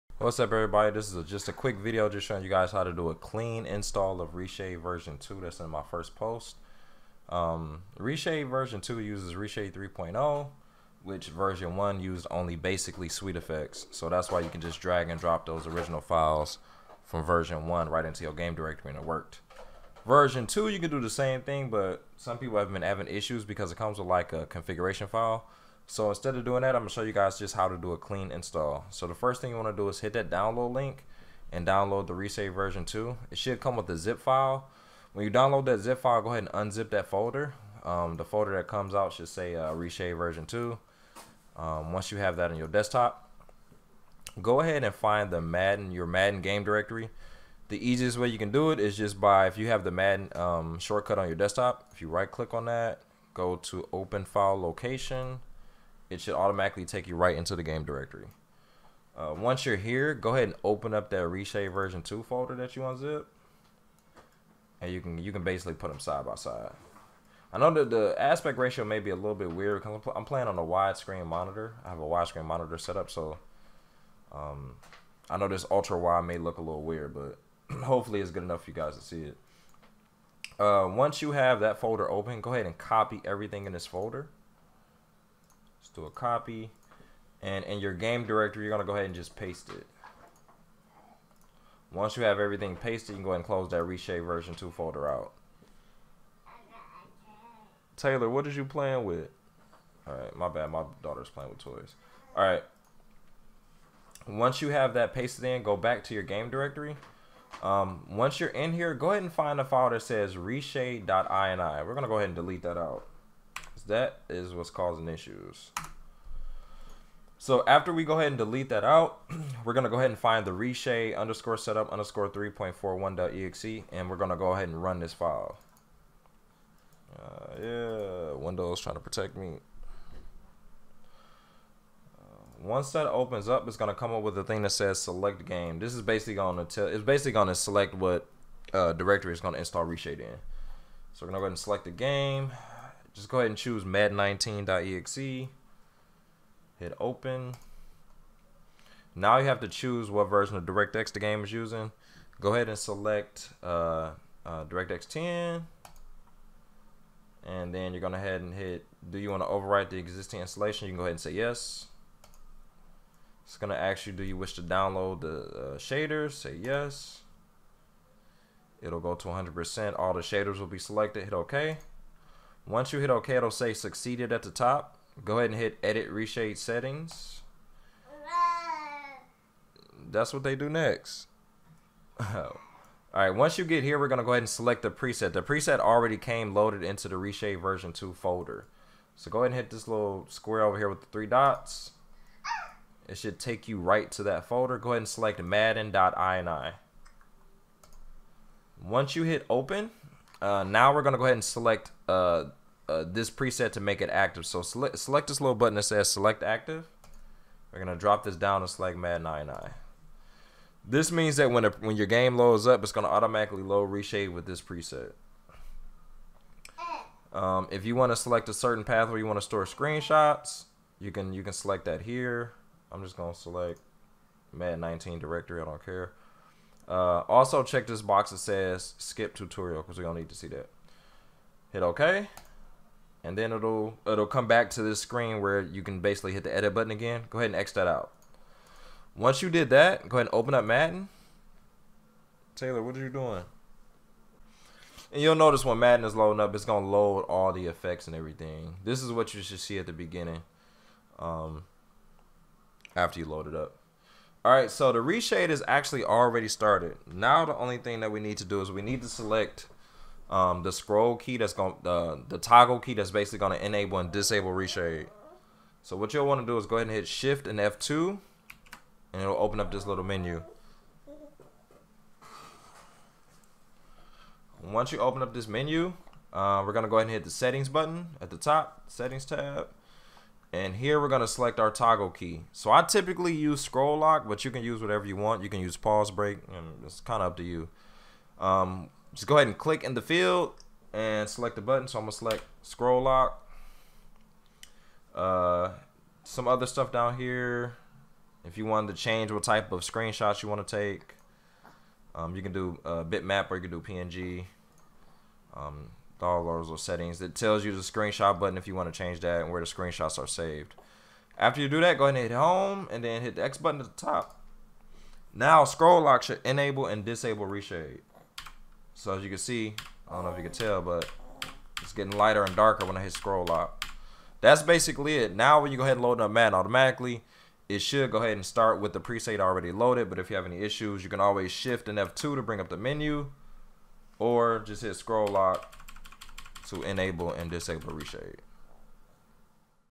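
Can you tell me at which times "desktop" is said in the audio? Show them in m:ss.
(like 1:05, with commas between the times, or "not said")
0:42, 0:51.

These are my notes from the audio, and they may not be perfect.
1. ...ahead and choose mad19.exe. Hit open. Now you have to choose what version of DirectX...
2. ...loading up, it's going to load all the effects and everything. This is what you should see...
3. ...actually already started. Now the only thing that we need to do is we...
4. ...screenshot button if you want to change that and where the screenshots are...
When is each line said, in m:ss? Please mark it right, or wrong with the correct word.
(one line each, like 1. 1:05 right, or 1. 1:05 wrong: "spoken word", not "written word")
1. 2:23 right
2. 4:06 right
3. 4:15 right
4. 5:07 right.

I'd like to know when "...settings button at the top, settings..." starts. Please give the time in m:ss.
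4:37.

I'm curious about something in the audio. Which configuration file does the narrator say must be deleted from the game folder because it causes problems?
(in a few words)
reshade.ini.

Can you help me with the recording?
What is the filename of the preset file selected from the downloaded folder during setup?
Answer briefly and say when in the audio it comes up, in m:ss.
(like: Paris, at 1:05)
madden.ini, at 3:15.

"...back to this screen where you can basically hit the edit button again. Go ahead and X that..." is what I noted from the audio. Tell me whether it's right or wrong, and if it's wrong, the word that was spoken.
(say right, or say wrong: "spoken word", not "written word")
right.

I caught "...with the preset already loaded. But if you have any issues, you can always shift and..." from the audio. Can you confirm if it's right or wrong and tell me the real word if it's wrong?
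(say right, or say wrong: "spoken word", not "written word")
right.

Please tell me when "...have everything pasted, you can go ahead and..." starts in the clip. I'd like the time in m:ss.
1:32.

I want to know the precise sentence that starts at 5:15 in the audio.
Now scroll lock should enable and disable reshade.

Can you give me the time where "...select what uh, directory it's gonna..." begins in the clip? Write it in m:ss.
2:17.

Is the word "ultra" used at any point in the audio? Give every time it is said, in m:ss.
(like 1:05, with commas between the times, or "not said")
1:15.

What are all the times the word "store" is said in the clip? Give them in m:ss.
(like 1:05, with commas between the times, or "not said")
3:39.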